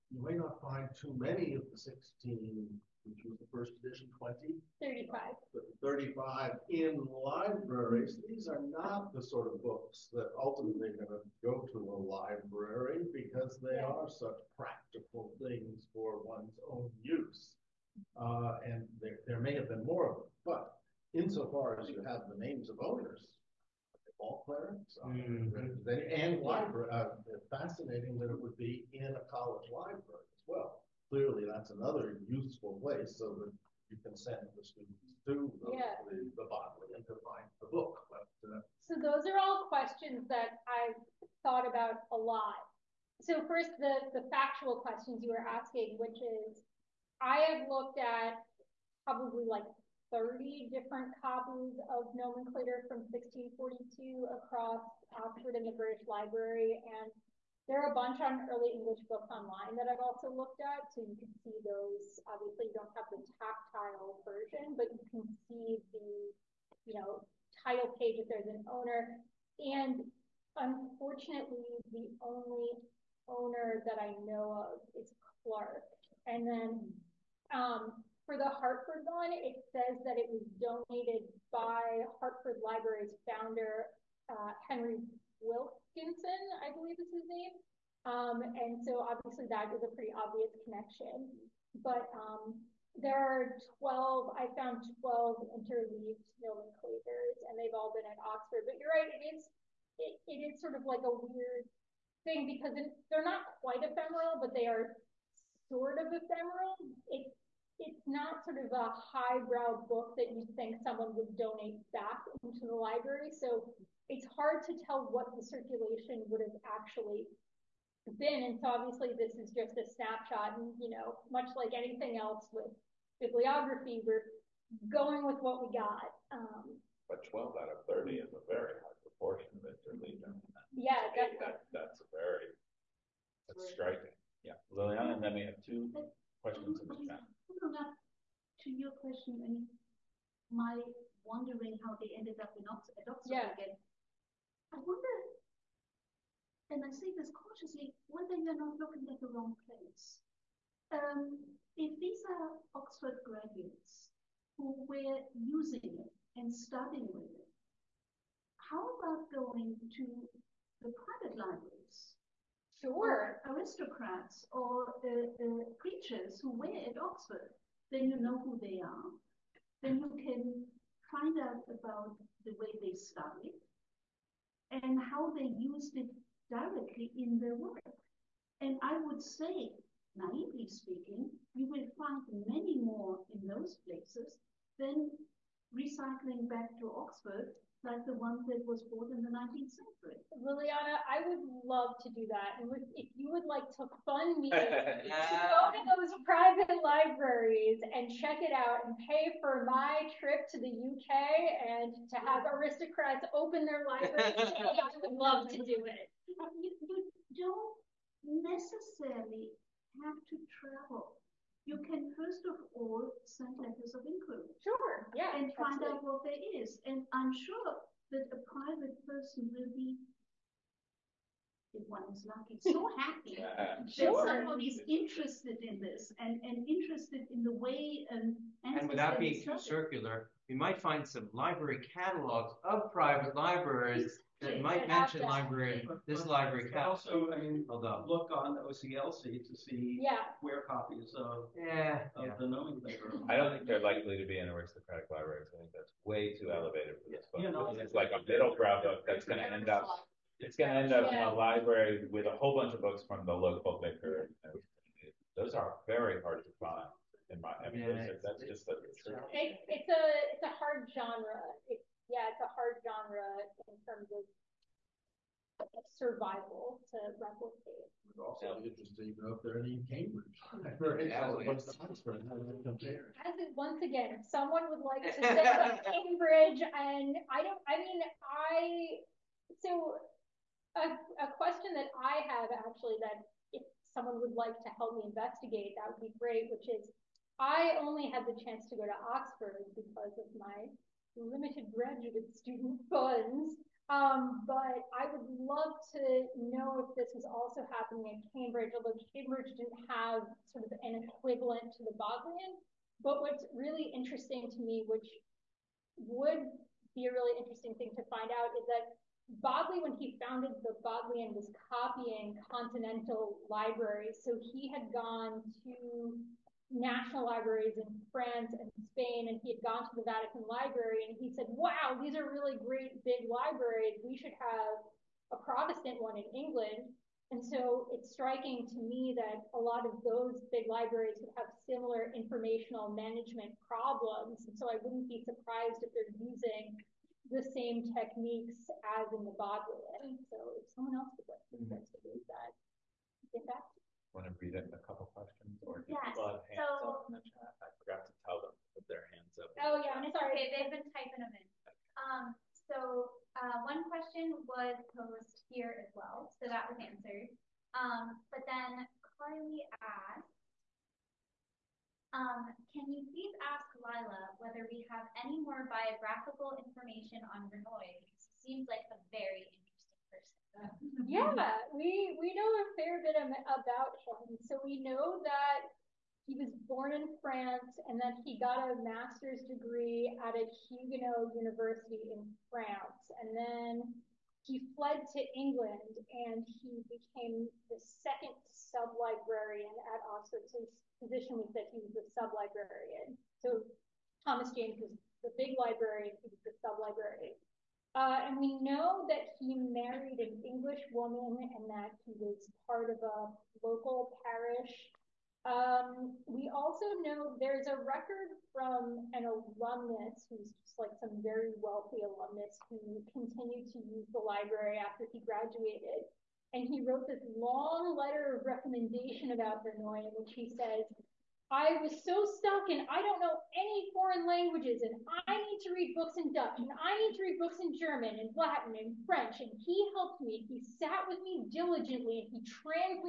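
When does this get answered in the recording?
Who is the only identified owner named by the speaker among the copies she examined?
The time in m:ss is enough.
1:15.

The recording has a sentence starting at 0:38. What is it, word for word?
But, uh, so those are all questions that I've thought about a lot.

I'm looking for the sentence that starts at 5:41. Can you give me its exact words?
investigate that, get back to Want to read it in a couple questions or yes.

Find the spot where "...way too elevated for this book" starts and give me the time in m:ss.
4:06.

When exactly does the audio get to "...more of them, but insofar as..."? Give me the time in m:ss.
0:19.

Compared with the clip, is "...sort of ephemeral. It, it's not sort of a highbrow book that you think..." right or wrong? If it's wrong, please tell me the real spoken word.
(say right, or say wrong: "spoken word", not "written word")
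right.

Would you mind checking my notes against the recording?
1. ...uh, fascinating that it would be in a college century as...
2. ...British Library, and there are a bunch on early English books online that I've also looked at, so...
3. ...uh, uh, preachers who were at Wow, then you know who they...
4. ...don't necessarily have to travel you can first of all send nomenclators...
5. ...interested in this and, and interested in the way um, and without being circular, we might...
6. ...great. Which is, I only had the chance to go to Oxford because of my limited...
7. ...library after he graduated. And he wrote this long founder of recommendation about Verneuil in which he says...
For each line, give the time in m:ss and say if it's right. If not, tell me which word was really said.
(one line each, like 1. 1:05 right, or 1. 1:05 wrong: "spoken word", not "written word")
1. 0:26 wrong: "library", not "century"
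2. 0:55 right
3. 2:45 wrong: "Oxford", not "Wow"
4. 3:27 wrong: "letters", not "nomenclators"
5. 3:44 right
6. 4:46 right
7. 6:54 wrong: "letter", not "founder".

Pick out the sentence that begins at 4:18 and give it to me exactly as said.
it's- It's, it's a, it's a hard genre.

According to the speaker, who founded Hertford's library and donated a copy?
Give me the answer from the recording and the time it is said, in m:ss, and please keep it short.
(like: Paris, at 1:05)
Henry Wilkes, at 1:24.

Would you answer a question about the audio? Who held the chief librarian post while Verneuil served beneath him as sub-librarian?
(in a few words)
Thomas James.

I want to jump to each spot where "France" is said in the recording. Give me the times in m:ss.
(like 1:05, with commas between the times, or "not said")
5:18, 6:17, 6:22.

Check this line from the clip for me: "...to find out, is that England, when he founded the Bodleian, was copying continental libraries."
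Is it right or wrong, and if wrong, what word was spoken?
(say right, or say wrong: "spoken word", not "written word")
wrong: "Bodley", not "England".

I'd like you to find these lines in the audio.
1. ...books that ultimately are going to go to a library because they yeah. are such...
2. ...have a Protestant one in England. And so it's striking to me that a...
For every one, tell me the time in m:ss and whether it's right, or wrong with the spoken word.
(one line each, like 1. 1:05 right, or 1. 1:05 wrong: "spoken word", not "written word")
1. 0:09 right
2. 5:24 right.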